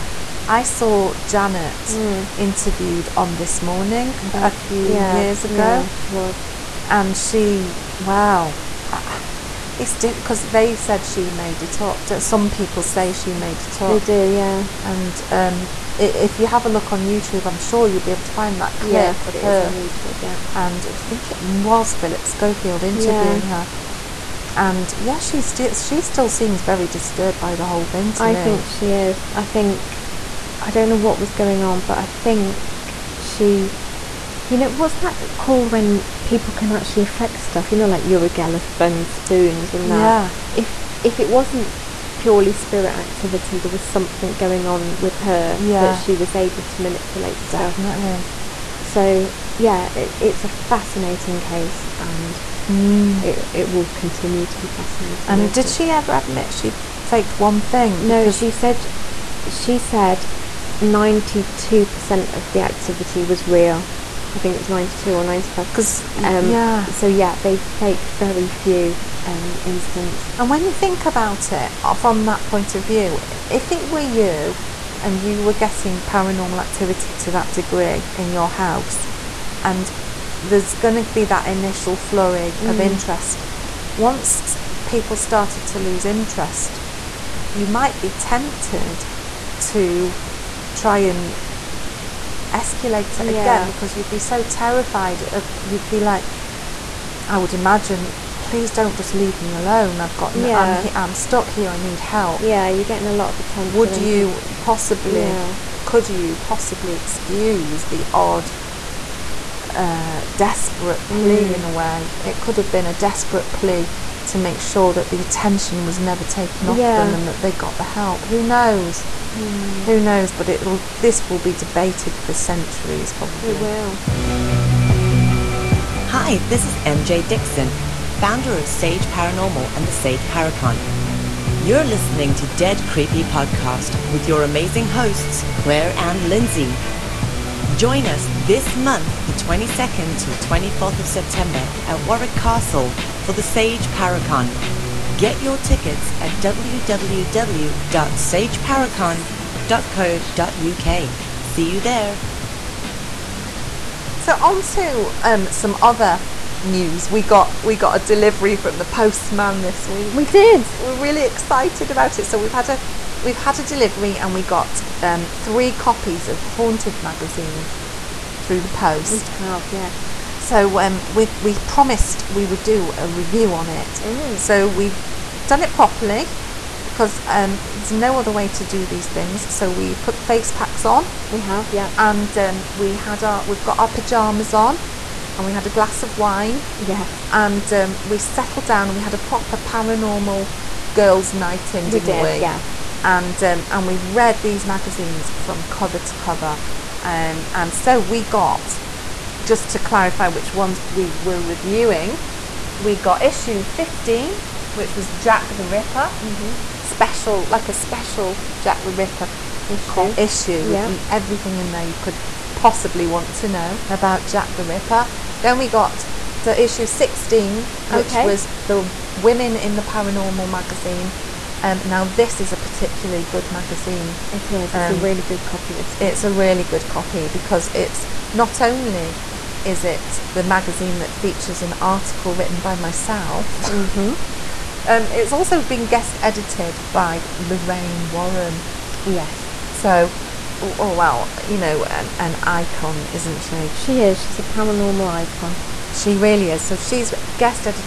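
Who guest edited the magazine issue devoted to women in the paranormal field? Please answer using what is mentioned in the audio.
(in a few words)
Lorraine Warren.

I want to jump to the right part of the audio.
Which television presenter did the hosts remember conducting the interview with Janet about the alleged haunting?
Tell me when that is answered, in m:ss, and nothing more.
0:21.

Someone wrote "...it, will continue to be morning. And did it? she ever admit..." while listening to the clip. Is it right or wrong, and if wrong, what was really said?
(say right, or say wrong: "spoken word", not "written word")
wrong: "fascinating", not "morning".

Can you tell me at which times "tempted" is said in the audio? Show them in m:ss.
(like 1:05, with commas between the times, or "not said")
1:28.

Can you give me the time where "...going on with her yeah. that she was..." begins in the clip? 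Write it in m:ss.
0:44.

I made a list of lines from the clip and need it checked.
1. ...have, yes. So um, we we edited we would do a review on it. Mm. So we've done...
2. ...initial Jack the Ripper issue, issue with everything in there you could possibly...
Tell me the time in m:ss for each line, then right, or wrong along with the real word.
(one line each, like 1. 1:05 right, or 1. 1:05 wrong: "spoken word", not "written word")
1. 2:49 wrong: "promised", not "edited"
2. 3:27 wrong: "special", not "initial".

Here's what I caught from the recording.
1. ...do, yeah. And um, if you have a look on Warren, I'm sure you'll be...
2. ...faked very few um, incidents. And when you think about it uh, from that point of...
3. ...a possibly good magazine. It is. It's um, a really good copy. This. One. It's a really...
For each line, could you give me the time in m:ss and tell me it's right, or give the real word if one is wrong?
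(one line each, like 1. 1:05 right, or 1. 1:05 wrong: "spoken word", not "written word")
1. 0:14 wrong: "YouTube", not "Warren"
2. 1:07 right
3. 3:42 wrong: "particularly", not "possibly".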